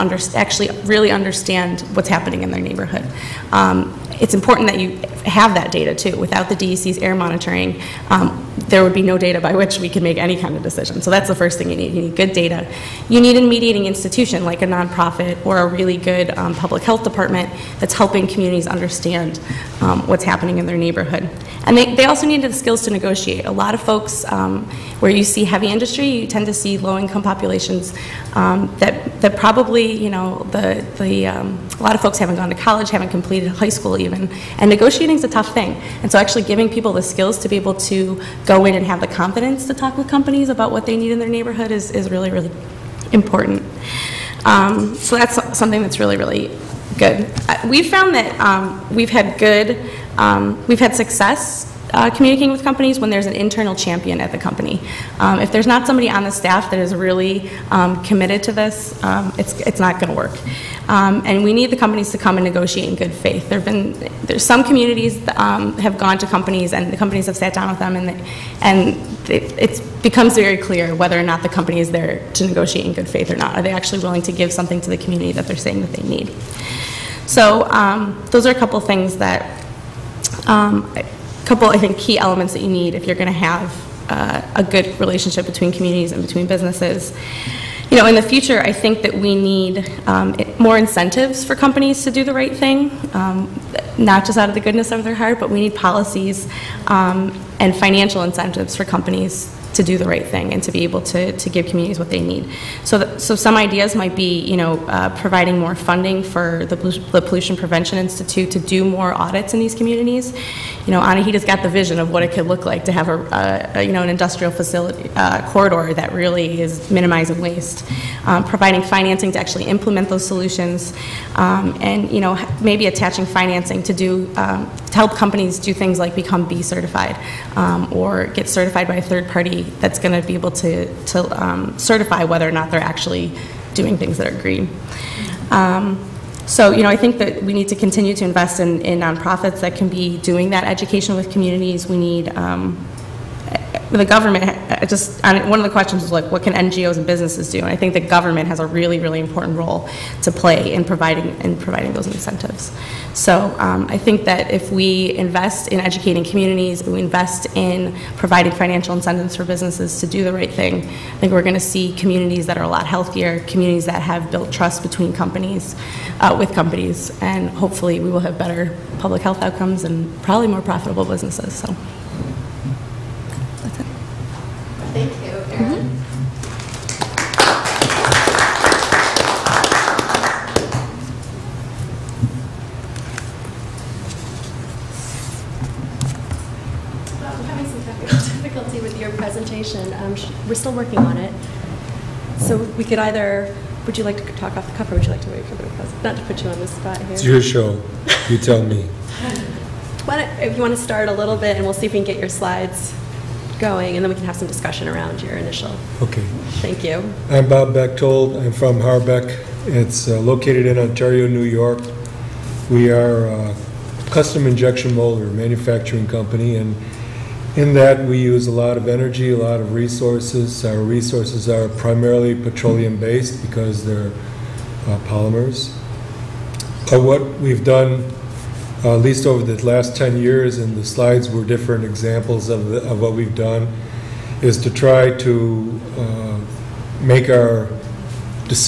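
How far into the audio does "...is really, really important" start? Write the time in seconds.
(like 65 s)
41 s.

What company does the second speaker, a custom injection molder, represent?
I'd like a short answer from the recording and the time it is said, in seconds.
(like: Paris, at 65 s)
Harbec, at 208 s.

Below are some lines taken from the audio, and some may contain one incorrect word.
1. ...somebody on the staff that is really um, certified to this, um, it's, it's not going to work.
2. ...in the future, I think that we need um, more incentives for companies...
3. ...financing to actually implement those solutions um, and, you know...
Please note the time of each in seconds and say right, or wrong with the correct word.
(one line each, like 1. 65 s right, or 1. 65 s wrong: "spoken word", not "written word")
1. 55 s wrong: "committed", not "certified"
2. 88 s right
3. 118 s right.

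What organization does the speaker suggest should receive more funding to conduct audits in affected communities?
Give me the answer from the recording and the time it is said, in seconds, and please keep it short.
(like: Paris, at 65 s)
Pollution Prevention Institute, at 107 s.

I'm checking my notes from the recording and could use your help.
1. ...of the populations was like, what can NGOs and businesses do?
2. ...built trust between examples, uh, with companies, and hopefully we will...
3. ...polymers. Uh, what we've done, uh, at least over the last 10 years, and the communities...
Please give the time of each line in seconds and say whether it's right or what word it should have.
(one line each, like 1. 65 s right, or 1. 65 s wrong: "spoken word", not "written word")
1. 145 s wrong: "questions", not "populations"
2. 164 s wrong: "companies", not "examples"
3. 225 s wrong: "slides", not "communities".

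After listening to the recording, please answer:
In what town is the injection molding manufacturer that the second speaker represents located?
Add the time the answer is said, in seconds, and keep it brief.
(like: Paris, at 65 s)
Ontario, New York, at 210 s.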